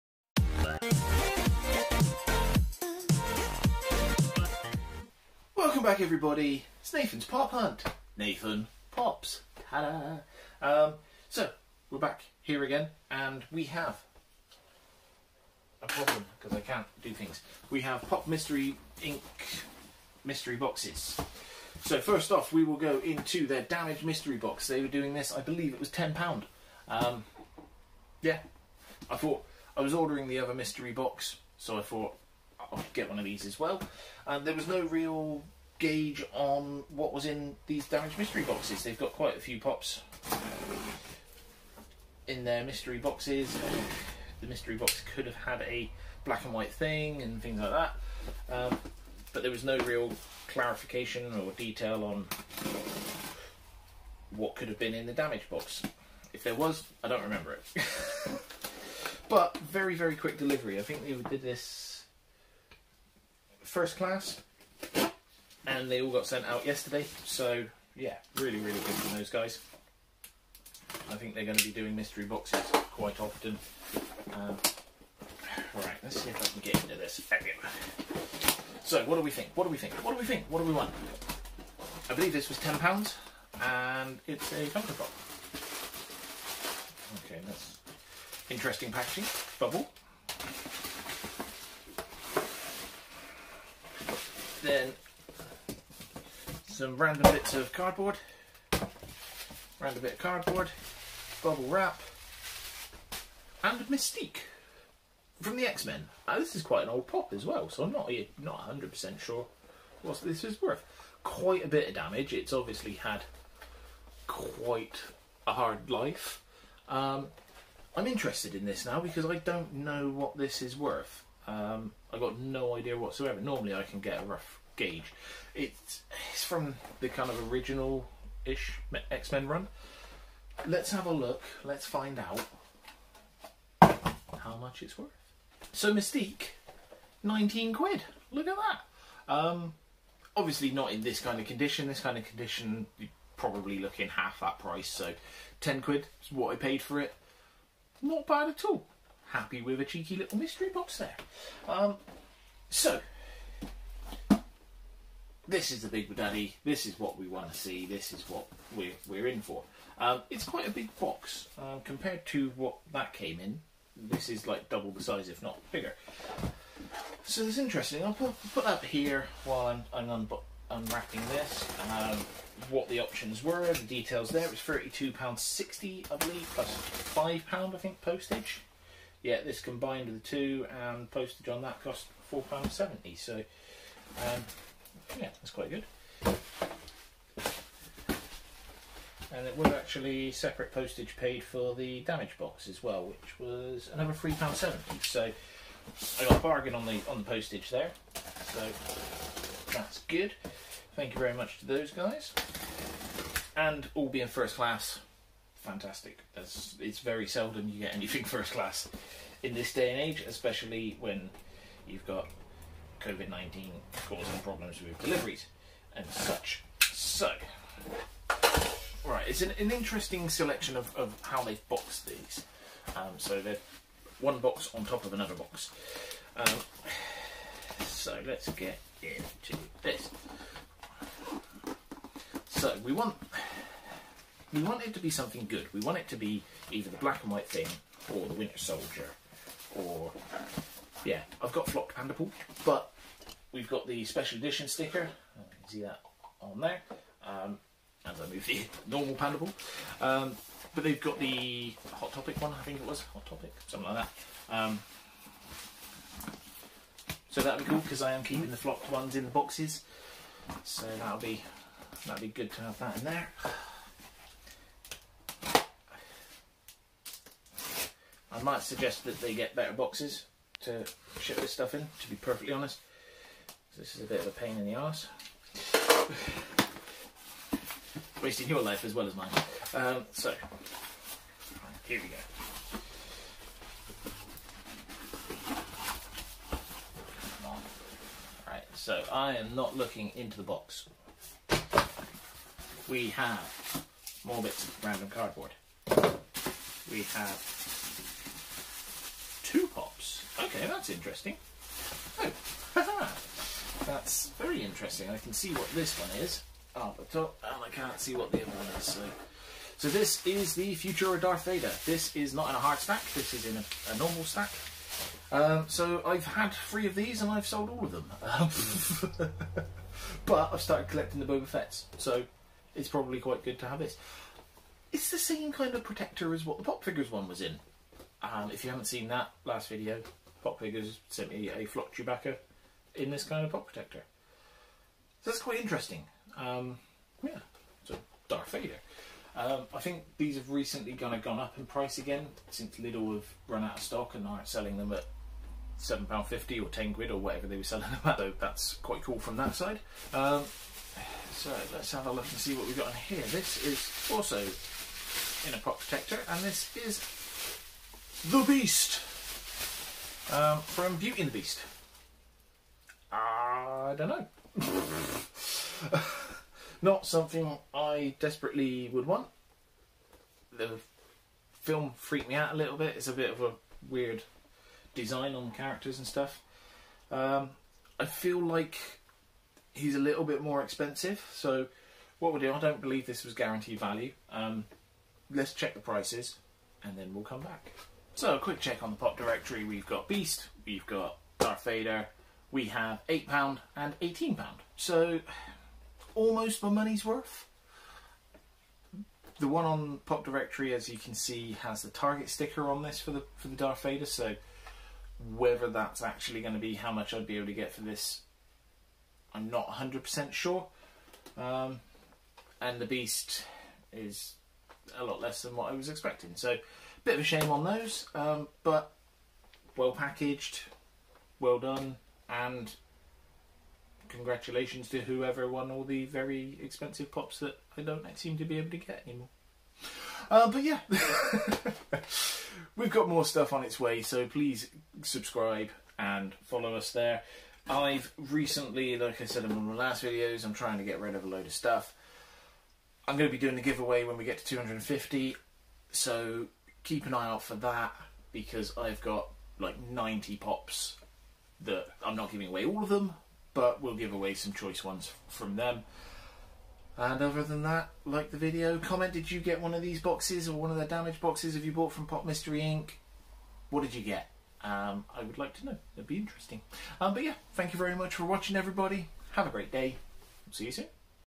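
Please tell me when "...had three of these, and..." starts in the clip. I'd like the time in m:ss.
5:16.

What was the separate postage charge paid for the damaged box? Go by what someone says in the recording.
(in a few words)
£3.70.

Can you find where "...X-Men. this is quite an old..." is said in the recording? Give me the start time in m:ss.
1:45.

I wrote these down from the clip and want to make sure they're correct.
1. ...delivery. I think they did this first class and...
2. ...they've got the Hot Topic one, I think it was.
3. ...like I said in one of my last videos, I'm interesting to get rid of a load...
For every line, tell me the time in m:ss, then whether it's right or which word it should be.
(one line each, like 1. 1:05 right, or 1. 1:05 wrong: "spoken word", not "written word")
1. 1:00 right
2. 4:10 right
3. 7:18 wrong: "trying", not "interesting".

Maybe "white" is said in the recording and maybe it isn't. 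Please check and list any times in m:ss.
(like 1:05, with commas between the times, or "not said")
0:46, 3:57.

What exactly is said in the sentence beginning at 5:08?
So, so this is the Futura Darth Vader.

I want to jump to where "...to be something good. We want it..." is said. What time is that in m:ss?
3:54.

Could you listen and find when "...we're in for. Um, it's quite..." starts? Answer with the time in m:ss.
2:39.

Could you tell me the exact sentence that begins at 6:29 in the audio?
We've got Beast, we've got Darth Vader, we have £8 and £18.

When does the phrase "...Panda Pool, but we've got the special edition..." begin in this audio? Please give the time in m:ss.
4:01.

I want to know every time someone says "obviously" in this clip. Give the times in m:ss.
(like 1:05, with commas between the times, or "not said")
1:52, 2:20.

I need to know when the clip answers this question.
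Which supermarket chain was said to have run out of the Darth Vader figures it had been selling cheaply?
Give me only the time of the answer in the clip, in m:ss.
5:42.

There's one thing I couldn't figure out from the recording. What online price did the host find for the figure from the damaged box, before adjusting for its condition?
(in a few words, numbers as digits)
£19.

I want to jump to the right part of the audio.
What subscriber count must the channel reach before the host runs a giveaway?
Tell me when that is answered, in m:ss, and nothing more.
7:24.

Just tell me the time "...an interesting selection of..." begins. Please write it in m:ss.
3:39.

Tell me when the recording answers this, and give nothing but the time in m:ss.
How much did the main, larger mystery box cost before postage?
2:54.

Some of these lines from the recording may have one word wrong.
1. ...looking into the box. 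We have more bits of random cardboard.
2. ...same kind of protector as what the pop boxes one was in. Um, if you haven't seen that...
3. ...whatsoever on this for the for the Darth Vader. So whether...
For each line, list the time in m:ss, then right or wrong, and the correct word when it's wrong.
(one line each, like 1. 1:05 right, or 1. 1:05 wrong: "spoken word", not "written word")
1. 4:49 right
2. 5:25 wrong: "figures", not "boxes"
3. 6:42 wrong: "sticker", not "whatsoever".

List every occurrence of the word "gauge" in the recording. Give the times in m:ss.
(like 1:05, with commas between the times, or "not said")
0:35, 2:04.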